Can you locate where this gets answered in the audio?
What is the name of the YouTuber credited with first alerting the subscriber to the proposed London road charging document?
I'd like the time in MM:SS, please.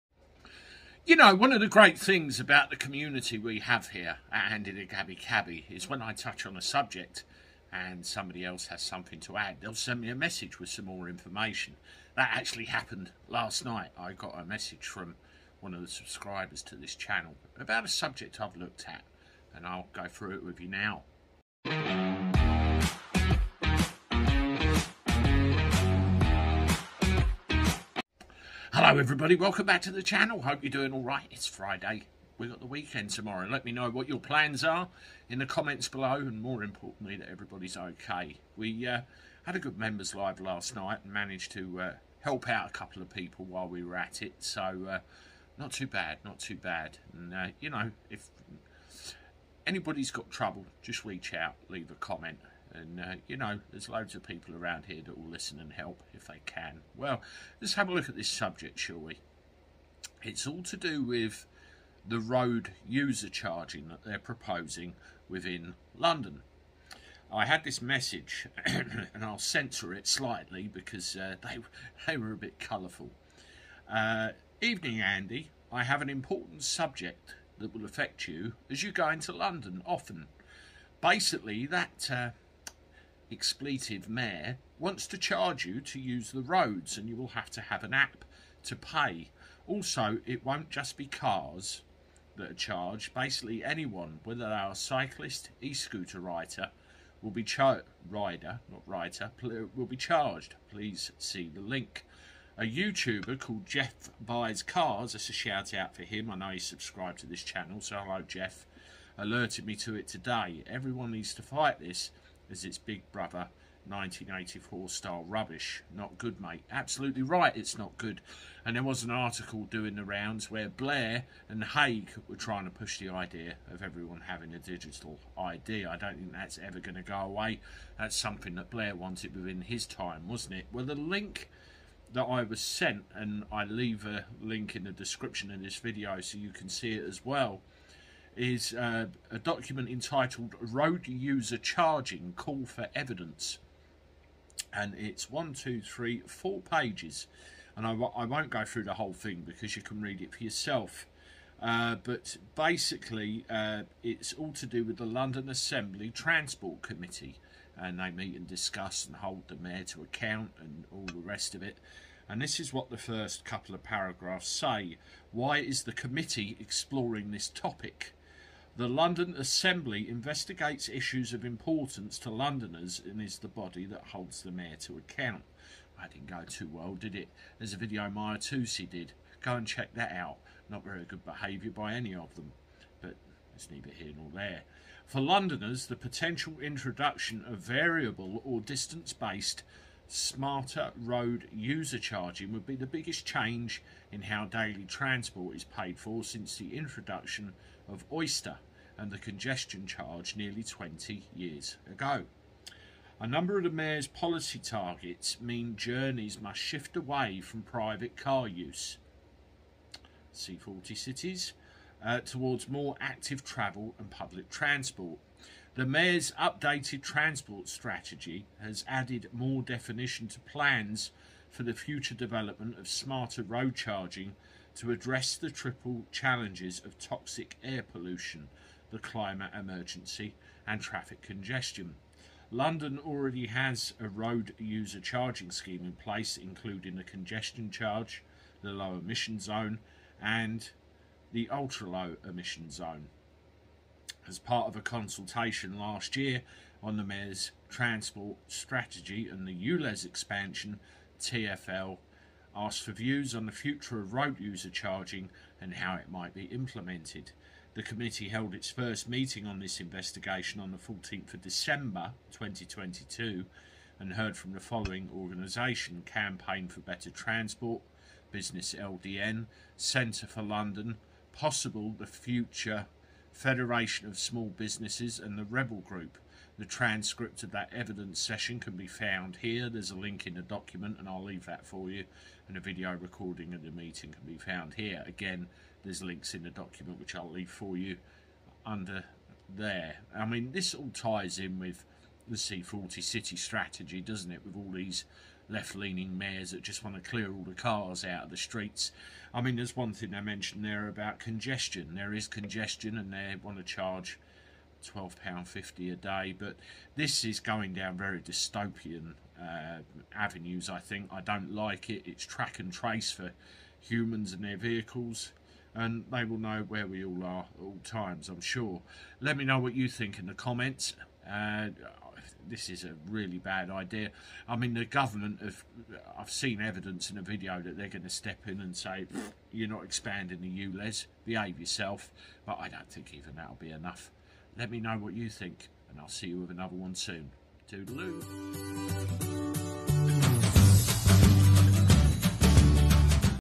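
01:43.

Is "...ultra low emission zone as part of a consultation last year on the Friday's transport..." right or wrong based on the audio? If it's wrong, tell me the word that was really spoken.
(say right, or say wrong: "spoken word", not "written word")
wrong: "Mayor", not "Friday".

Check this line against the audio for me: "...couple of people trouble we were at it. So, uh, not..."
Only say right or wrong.
wrong.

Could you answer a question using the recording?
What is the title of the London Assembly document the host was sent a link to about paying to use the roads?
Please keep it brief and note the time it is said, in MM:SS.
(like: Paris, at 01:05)
Road User Charging Call for Evidence, at 02:20.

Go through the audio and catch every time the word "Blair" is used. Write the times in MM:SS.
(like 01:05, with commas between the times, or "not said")
02:00, 02:08.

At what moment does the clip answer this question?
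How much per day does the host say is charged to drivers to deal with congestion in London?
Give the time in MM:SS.
05:04.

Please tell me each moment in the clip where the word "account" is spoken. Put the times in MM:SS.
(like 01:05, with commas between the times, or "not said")
02:40, 02:54.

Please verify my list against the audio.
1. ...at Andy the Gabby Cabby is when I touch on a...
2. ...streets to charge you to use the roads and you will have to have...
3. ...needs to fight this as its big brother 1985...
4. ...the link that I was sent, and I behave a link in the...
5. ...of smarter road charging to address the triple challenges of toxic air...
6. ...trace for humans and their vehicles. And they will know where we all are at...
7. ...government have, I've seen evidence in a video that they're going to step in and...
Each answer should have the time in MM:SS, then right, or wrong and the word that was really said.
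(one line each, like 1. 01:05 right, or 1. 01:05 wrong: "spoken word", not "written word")
1. 00:04 right
2. 01:24 wrong: "wants", not "streets"
3. 01:51 wrong: "1984", not "1985"
4. 02:10 wrong: "leave", not "behave"
5. 03:42 right
6. 05:12 right
7. 05:24 right.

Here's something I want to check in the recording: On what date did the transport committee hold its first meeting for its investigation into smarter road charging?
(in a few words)
14 December 2022.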